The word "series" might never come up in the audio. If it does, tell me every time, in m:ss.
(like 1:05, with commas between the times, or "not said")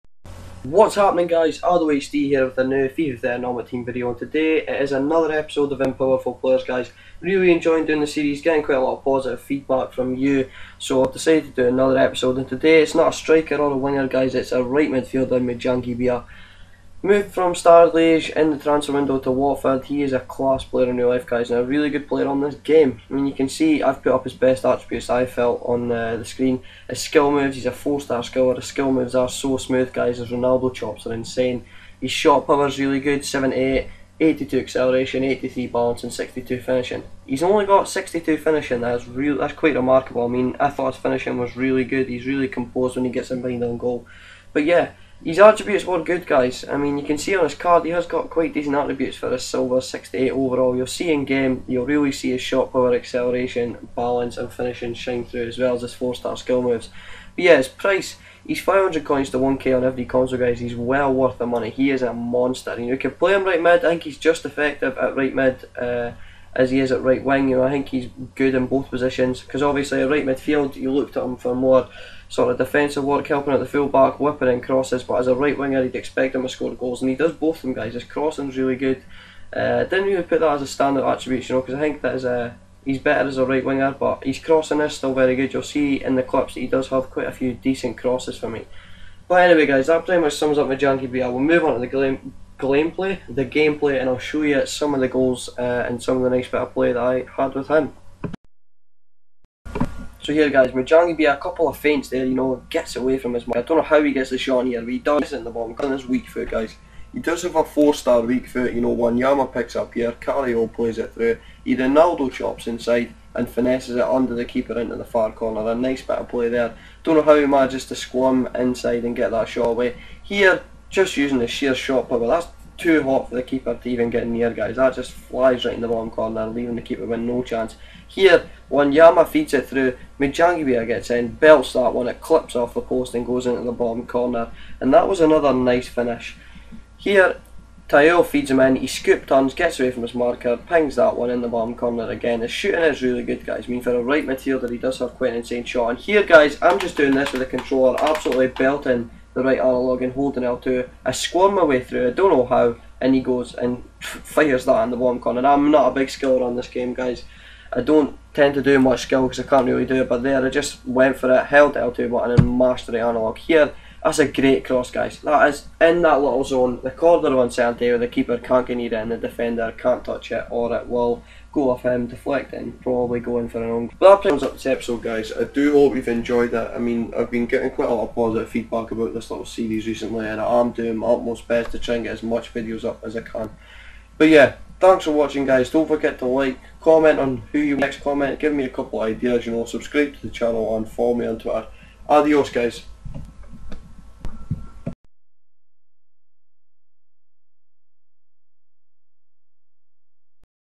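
0:08, 2:59.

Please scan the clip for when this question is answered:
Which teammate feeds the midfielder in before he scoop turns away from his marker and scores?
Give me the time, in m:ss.
2:17.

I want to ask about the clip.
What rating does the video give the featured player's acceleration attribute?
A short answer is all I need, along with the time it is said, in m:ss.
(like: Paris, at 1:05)
82, at 0:34.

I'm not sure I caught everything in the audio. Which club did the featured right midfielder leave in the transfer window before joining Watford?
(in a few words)
Standard Liège.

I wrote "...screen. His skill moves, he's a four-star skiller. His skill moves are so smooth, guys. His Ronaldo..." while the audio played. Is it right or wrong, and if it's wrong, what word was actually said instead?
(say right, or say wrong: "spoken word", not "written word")
right.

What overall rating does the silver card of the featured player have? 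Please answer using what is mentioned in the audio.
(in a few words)
68.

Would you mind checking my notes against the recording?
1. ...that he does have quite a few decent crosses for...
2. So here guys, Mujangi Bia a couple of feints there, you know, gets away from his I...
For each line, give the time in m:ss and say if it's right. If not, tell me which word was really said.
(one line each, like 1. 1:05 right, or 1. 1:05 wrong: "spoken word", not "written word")
1. 1:26 right
2. 1:40 right.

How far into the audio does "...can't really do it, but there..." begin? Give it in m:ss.
2:39.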